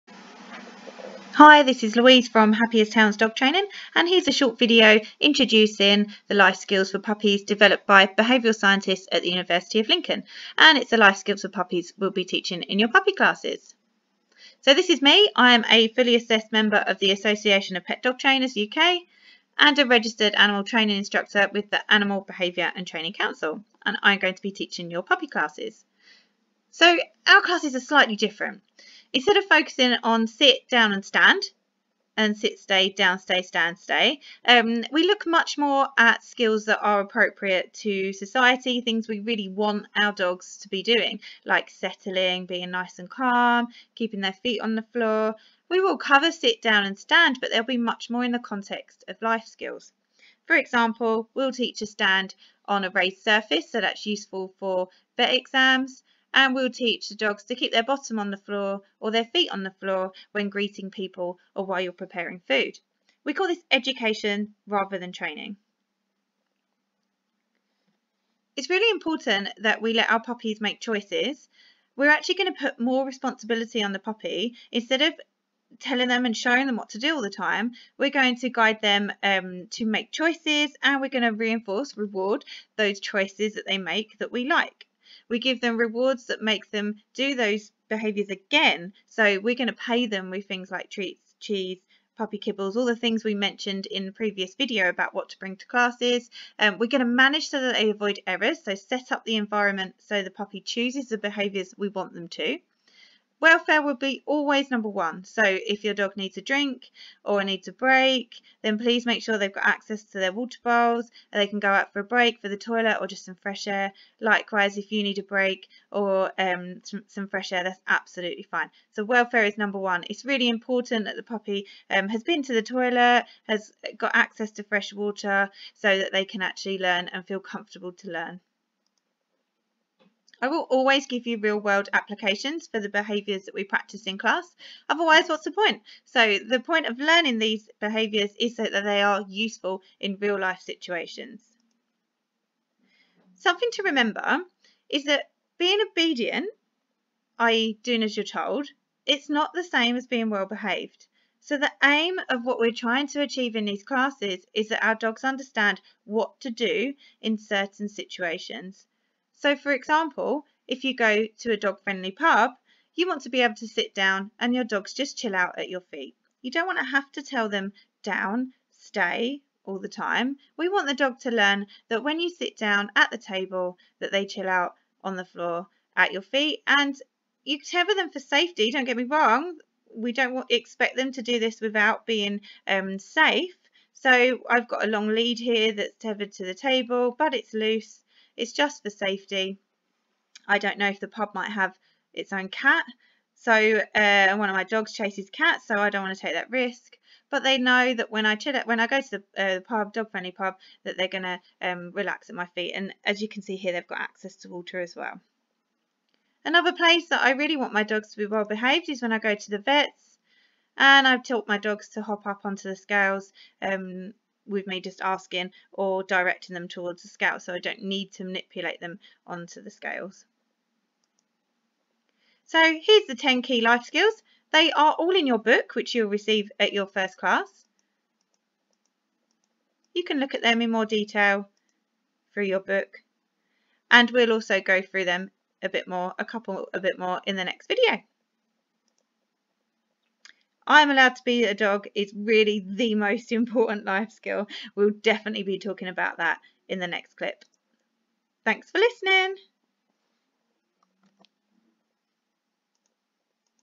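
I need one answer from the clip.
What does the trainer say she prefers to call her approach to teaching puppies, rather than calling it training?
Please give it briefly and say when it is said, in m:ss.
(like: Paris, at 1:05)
Education, at 1:03.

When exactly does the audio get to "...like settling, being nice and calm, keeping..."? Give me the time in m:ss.
0:41.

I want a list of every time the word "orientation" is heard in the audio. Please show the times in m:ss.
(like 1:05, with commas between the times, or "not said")
not said.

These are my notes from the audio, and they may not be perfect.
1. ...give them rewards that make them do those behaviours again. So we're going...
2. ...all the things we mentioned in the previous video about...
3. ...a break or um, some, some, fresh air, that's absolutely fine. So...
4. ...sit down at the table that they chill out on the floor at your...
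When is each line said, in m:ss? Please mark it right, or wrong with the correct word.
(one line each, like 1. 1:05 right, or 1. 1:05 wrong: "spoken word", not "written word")
1. 1:25 right
2. 1:32 right
3. 1:55 right
4. 2:52 right.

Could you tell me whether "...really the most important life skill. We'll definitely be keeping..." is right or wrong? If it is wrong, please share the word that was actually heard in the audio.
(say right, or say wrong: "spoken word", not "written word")
wrong: "talking", not "keeping".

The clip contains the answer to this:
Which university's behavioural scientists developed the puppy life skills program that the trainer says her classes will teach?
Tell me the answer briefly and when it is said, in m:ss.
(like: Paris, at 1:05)
University of Lincoln, at 0:09.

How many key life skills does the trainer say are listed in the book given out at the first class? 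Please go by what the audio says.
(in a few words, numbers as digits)
10.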